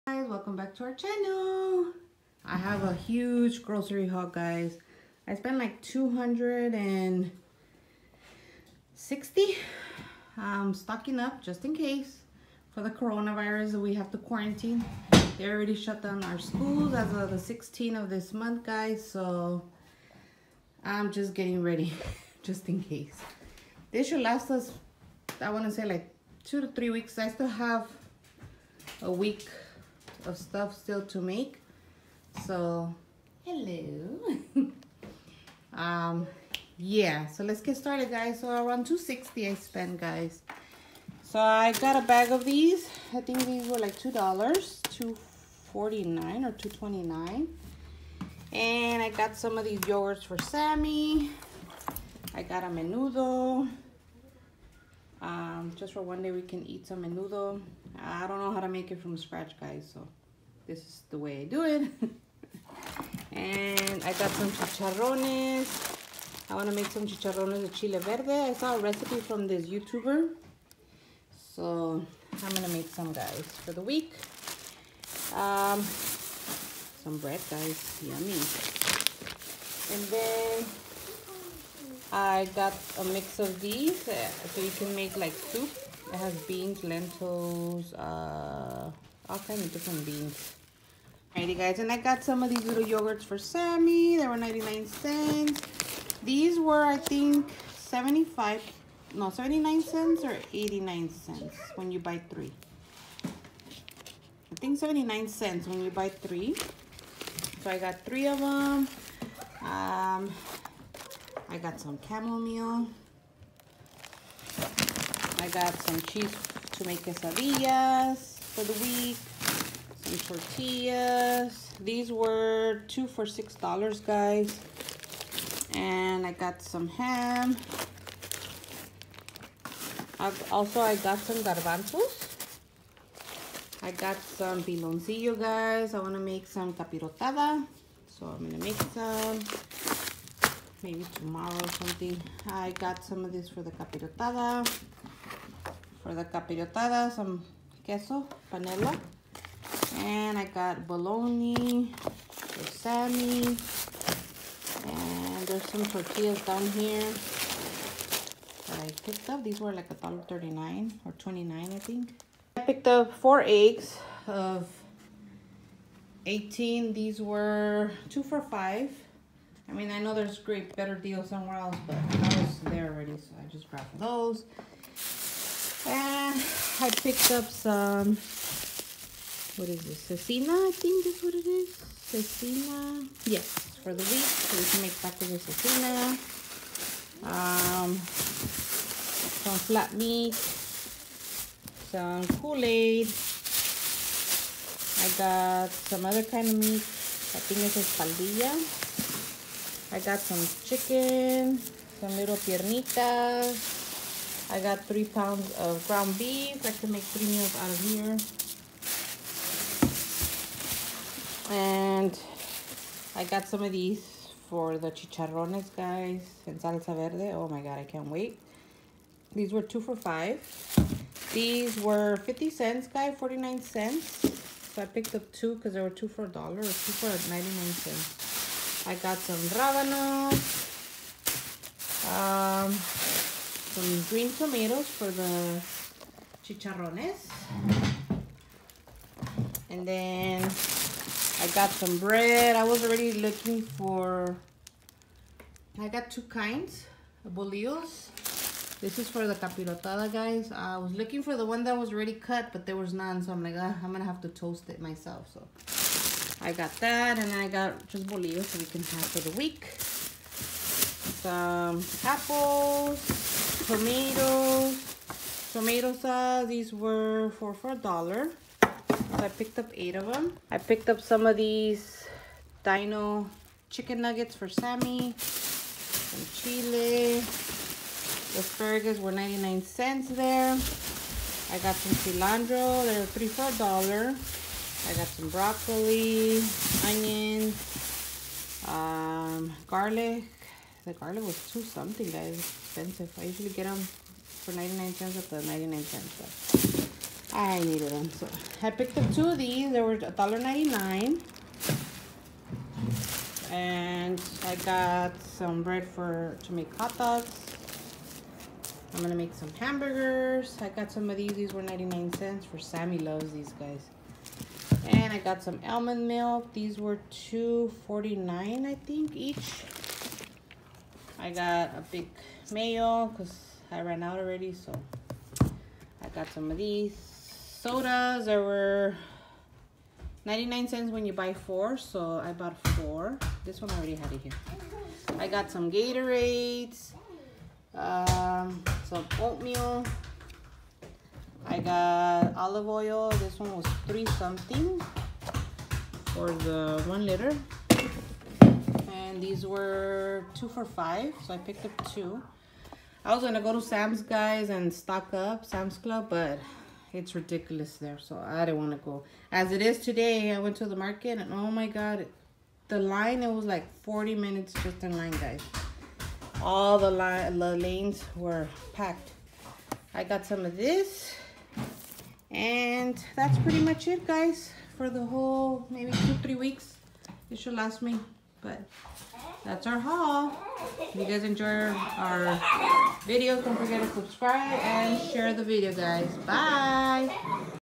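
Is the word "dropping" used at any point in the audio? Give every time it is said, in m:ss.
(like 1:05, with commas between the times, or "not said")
not said.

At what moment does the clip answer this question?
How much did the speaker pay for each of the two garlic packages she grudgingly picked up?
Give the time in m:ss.
4:59.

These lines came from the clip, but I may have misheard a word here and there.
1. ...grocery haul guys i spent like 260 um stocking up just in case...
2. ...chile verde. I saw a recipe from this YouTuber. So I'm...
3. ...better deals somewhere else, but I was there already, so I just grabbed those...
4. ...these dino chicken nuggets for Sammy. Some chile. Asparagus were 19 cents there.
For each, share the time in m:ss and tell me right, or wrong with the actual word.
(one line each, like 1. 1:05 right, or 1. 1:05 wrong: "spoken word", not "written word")
1. 0:03 right
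2. 1:07 right
3. 2:50 right
4. 4:31 wrong: "99", not "19".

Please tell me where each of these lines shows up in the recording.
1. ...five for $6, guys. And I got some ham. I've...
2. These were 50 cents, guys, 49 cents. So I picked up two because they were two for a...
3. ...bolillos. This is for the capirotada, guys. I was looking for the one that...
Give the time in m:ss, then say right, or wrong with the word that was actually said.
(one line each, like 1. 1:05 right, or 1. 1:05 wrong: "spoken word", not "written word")
1. 2:02 wrong: "two", not "five"
2. 3:41 right
3. 4:07 right.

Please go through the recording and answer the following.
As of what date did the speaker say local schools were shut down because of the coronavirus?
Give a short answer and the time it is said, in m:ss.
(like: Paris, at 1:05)
16th, at 0:17.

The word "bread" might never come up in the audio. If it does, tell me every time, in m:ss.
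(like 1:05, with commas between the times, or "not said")
1:17, 4:01, 5:05.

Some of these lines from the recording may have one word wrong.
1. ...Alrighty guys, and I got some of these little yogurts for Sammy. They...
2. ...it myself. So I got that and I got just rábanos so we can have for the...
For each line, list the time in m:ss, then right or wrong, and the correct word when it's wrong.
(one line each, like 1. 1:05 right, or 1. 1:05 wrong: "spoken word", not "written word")
1. 1:31 right
2. 4:14 wrong: "bolillos", not "rábanos".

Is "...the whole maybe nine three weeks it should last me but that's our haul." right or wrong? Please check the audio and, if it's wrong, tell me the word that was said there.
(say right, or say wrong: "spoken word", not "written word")
wrong: "two", not "nine".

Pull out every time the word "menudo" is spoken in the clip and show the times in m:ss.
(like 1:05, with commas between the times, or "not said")
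0:52, 0:57.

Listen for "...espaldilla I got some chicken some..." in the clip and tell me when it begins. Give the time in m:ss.
3:17.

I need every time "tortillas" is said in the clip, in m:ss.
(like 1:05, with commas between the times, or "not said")
2:00, 2:35.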